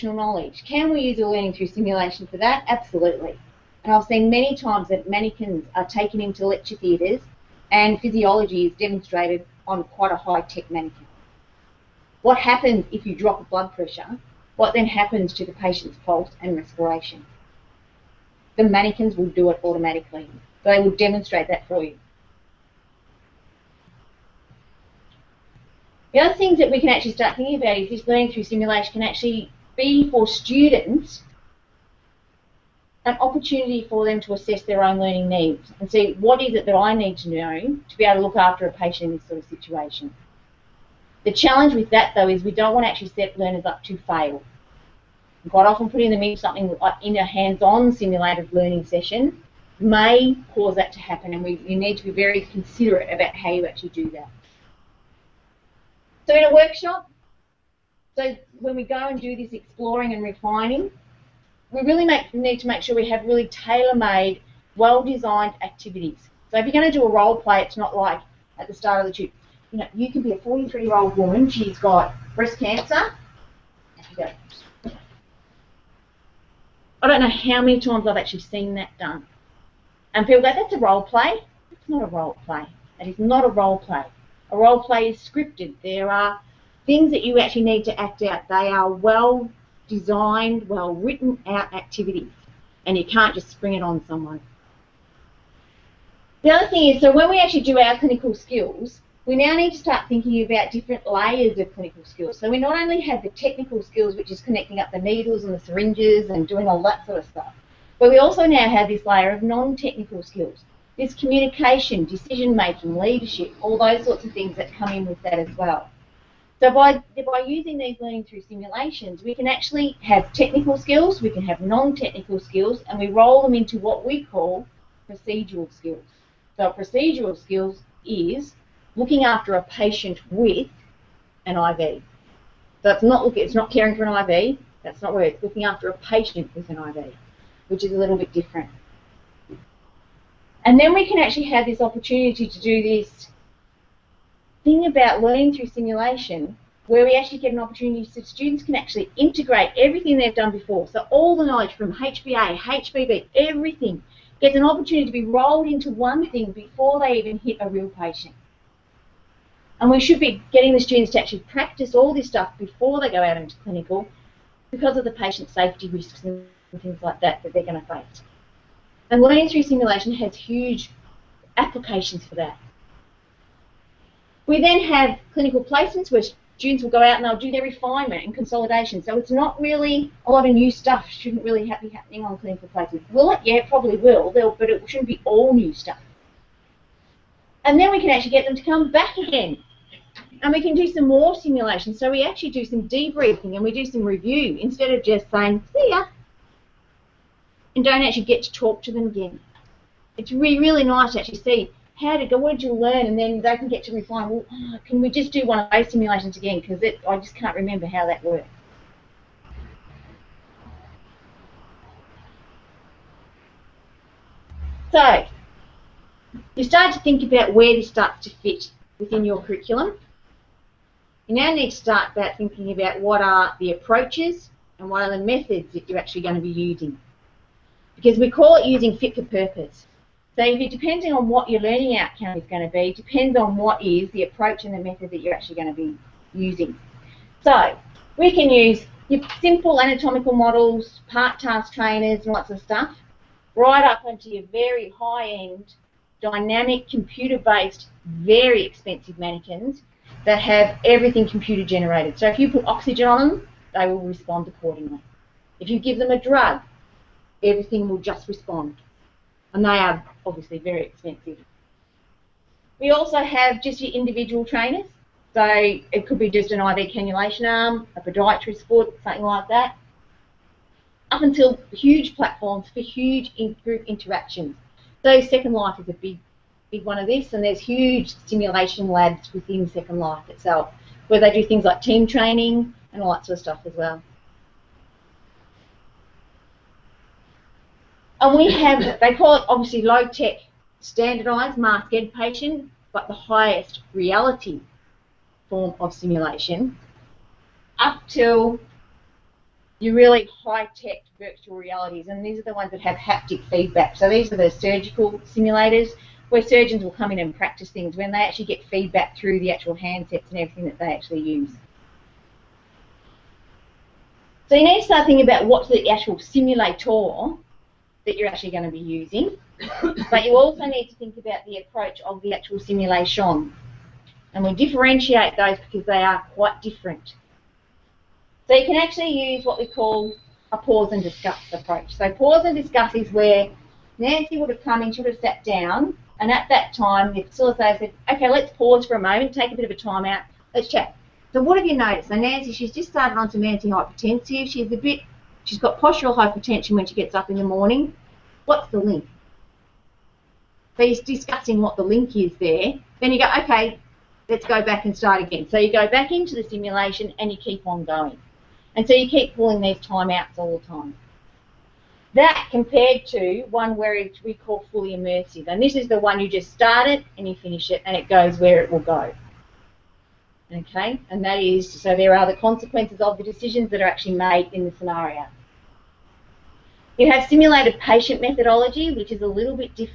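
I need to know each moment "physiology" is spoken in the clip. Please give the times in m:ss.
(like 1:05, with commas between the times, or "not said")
0:08.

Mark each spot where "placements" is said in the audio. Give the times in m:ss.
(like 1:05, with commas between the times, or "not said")
2:55, 3:02.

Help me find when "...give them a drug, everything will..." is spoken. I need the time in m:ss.
4:15.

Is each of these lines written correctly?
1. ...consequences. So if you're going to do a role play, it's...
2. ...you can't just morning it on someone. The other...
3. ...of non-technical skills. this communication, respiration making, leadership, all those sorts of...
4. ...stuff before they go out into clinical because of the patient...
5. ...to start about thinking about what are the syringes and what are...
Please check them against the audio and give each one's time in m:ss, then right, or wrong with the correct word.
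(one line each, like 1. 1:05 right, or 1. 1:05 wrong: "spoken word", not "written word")
1. 1:05 wrong: "activities", not "consequences"
2. 1:32 wrong: "spring", not "morning"
3. 1:49 wrong: "decision", not "respiration"
4. 2:42 right
5. 3:41 wrong: "approaches", not "syringes".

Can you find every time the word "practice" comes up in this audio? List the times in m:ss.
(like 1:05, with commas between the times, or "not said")
2:41, 5:07.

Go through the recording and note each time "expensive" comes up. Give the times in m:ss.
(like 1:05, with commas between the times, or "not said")
4:08, 4:20.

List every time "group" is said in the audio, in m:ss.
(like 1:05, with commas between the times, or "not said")
4:33.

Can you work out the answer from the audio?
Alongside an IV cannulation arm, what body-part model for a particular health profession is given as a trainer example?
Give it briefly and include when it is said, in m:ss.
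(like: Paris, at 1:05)
a podiatrist foot, at 4:27.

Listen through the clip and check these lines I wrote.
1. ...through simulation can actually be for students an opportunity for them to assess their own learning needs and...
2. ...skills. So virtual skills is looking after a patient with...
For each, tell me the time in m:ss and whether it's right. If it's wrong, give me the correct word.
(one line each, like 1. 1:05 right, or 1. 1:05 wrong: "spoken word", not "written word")
1. 0:28 right
2. 2:05 wrong: "procedural", not "virtual".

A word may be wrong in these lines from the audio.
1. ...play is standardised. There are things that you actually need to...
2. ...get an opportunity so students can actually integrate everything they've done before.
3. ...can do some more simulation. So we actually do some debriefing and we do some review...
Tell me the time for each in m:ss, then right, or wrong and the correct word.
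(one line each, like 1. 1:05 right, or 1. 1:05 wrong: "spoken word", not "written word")
1. 1:24 wrong: "scripted", not "standardised"
2. 2:27 right
3. 3:10 right.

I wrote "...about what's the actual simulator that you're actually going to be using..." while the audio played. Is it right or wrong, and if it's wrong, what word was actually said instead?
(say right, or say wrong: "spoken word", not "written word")
right.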